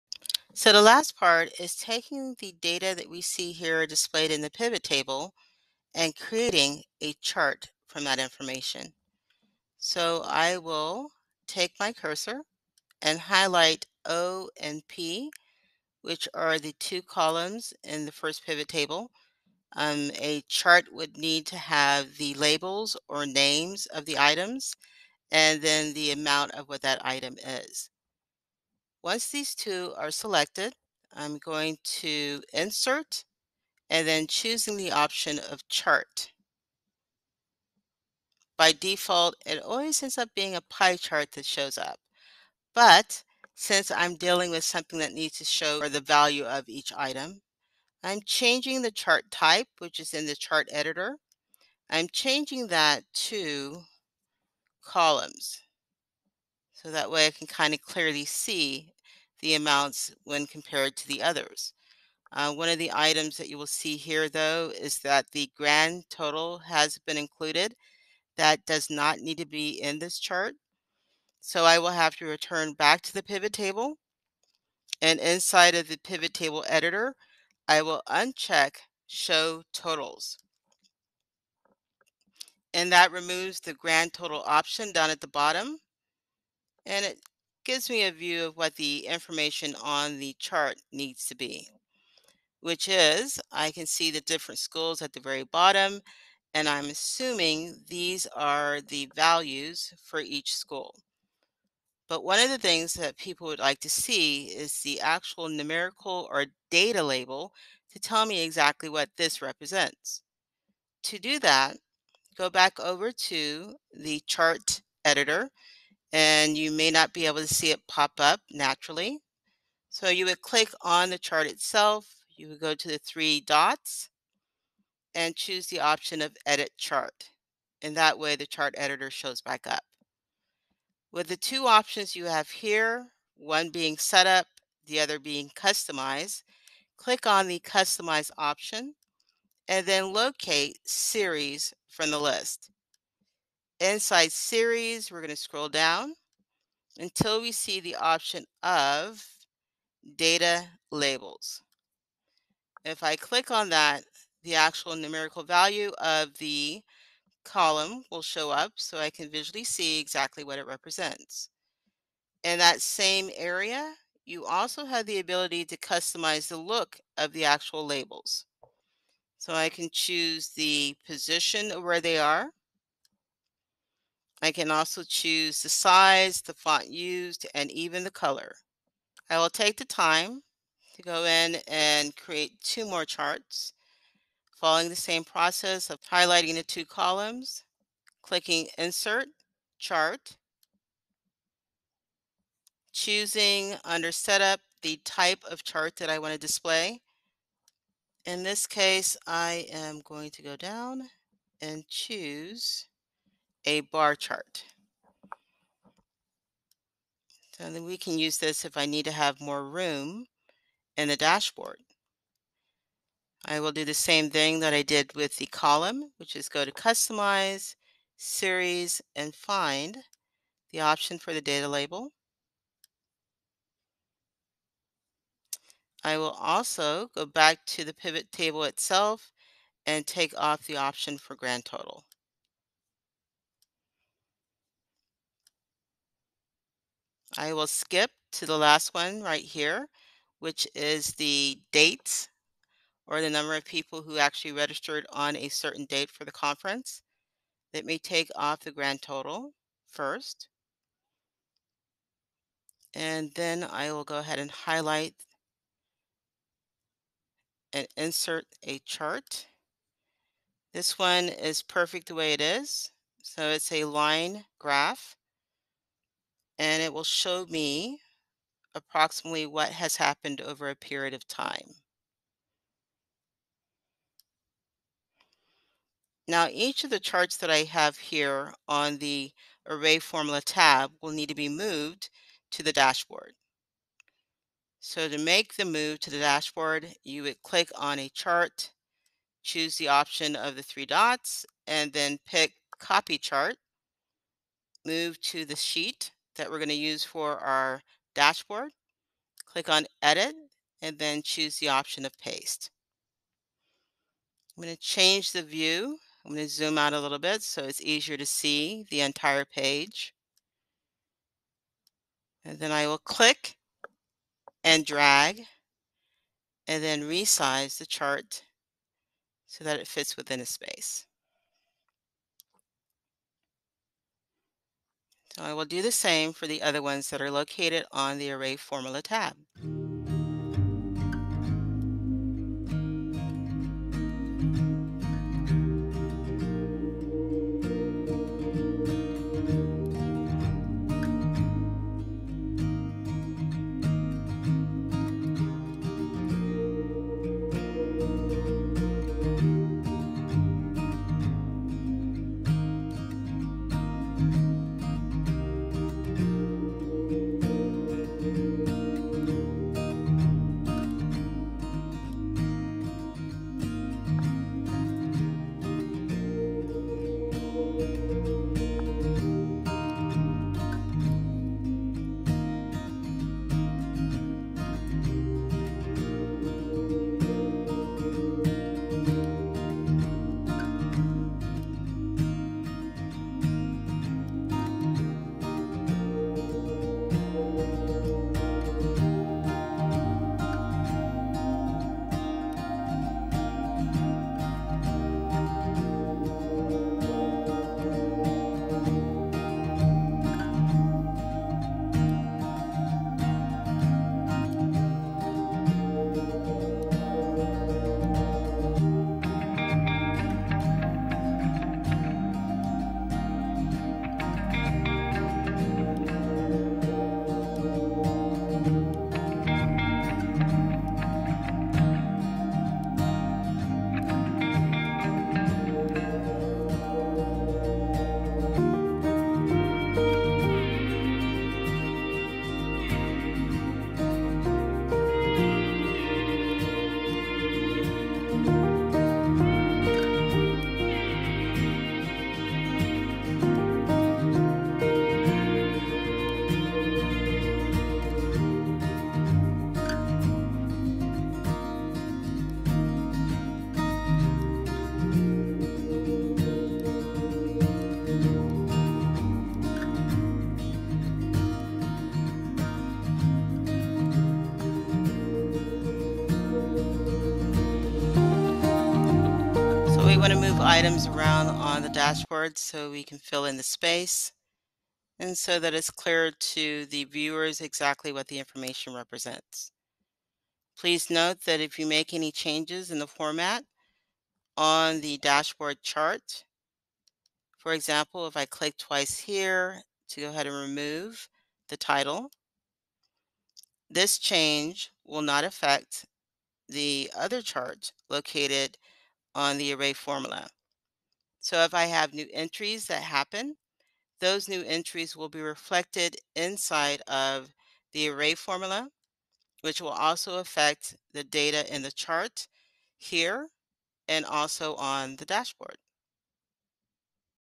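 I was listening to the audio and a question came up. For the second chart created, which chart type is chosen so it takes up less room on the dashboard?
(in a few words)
Bar chart.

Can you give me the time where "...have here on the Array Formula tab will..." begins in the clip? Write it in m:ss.
4:37.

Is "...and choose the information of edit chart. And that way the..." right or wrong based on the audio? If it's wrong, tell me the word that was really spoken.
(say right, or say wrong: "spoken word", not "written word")
wrong: "option", not "information".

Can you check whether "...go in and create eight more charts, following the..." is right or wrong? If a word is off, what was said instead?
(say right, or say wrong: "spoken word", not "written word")
wrong: "two", not "eight".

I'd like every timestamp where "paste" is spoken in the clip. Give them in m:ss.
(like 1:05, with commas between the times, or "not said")
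5:02.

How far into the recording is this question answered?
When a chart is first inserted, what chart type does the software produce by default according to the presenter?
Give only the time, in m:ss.
0:40.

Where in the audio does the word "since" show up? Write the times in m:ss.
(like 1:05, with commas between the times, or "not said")
0:43.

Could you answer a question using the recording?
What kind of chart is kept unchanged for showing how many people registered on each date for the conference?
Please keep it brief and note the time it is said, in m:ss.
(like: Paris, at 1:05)
Line graph, at 4:23.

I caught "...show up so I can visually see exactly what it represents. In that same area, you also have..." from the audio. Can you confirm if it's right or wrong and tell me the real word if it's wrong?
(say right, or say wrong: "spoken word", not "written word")
right.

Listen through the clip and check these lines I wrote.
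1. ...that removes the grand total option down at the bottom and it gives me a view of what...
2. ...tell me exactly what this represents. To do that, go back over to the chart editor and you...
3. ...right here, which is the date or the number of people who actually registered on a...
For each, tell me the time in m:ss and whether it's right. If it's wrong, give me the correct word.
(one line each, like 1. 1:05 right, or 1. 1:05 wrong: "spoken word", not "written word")
1. 1:22 right
2. 1:47 right
3. 3:59 right.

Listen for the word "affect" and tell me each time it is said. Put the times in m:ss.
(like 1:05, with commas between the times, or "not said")
8:15, 8:30.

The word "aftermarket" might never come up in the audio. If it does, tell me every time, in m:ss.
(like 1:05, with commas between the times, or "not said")
not said.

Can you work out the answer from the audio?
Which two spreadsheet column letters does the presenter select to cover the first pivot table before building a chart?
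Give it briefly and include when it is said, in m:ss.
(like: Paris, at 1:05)
O and P, at 0:14.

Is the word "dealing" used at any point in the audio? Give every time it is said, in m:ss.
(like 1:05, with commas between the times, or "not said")
0:44.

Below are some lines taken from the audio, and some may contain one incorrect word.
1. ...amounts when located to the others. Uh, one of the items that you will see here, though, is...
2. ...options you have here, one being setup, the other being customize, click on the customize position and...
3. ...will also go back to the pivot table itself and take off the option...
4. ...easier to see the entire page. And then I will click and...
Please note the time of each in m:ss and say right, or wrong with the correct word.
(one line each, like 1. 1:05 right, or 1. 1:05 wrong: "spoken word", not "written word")
1. 0:59 wrong: "compared", not "located"
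2. 2:11 wrong: "option", not "position"
3. 3:46 right
4. 5:07 right.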